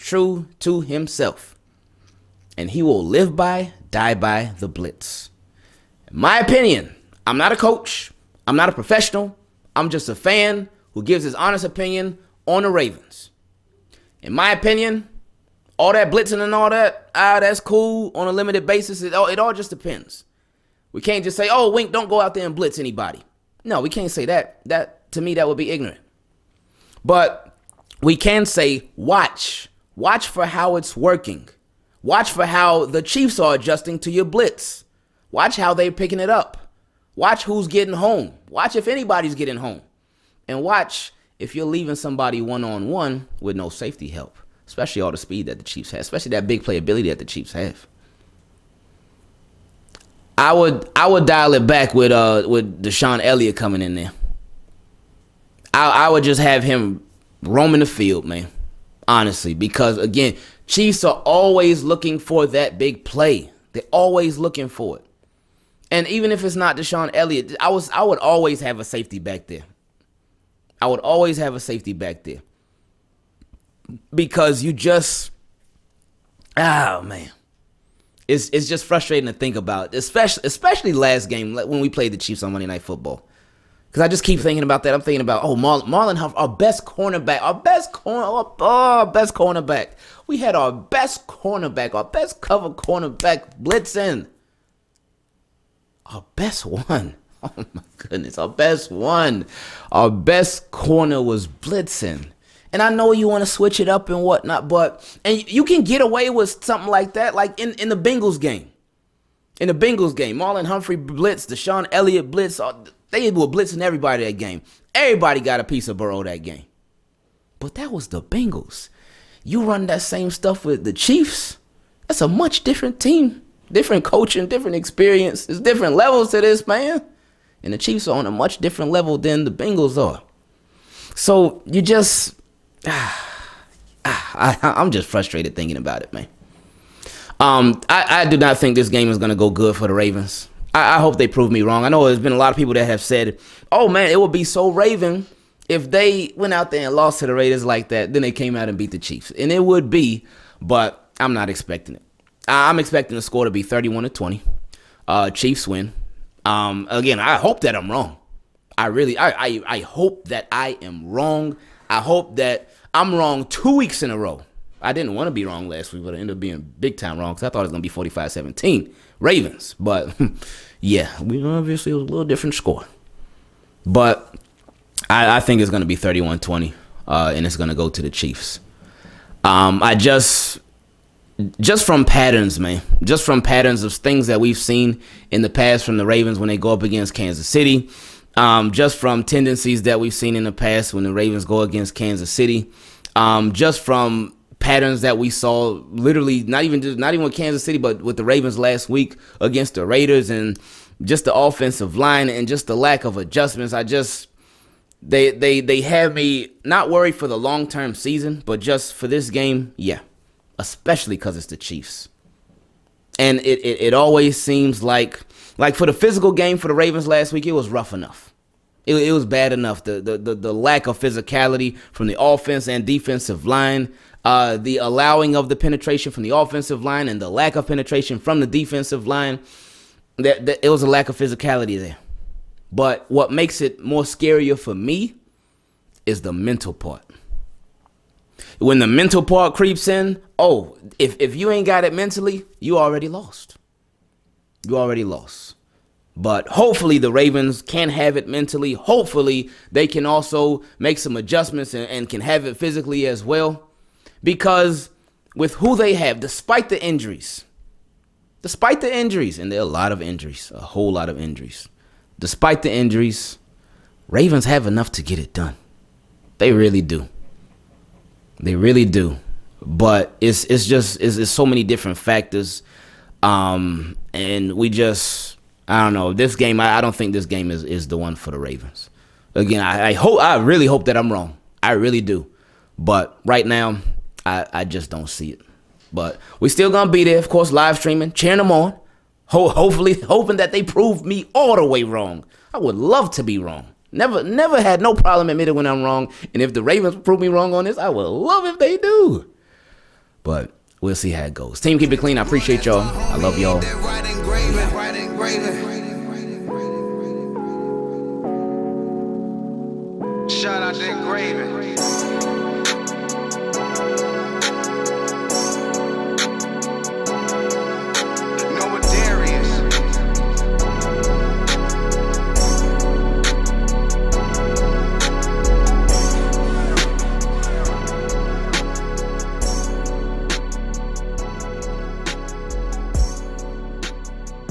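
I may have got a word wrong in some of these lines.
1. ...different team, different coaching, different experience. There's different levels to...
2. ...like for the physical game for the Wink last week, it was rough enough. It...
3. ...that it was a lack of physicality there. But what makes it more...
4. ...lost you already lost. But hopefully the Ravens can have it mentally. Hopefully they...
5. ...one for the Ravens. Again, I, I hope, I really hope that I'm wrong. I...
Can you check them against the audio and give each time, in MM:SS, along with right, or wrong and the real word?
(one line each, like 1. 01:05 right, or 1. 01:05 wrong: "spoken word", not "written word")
1. 02:02 right
2. 03:35 wrong: "Ravens", not "Wink"
3. 03:50 right
4. 04:03 right
5. 04:37 right.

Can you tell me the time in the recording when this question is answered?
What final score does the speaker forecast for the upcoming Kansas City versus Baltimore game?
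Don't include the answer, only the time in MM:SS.
02:33.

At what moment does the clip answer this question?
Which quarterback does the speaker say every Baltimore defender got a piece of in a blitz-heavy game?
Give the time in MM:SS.
01:55.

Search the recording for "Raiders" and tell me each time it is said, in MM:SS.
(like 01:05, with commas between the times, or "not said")
02:27, 03:19.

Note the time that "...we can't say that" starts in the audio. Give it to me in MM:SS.
00:23.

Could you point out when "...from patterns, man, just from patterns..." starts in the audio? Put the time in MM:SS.
03:01.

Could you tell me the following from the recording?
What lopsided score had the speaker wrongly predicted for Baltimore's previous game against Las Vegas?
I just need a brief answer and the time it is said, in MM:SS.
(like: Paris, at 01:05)
45-17, at 02:47.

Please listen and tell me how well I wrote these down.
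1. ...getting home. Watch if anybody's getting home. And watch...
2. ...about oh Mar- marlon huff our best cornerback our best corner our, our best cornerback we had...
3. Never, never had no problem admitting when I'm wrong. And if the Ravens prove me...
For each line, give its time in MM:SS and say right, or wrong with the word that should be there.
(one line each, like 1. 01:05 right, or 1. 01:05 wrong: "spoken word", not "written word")
1. 00:37 right
2. 01:25 right
3. 04:53 right.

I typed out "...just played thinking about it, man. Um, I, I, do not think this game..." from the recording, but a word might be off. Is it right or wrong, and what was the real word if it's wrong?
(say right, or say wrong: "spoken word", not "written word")
wrong: "frustrated", not "played".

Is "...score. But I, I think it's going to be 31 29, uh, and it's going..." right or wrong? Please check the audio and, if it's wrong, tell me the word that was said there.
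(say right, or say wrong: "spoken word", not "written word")
wrong: "20", not "29".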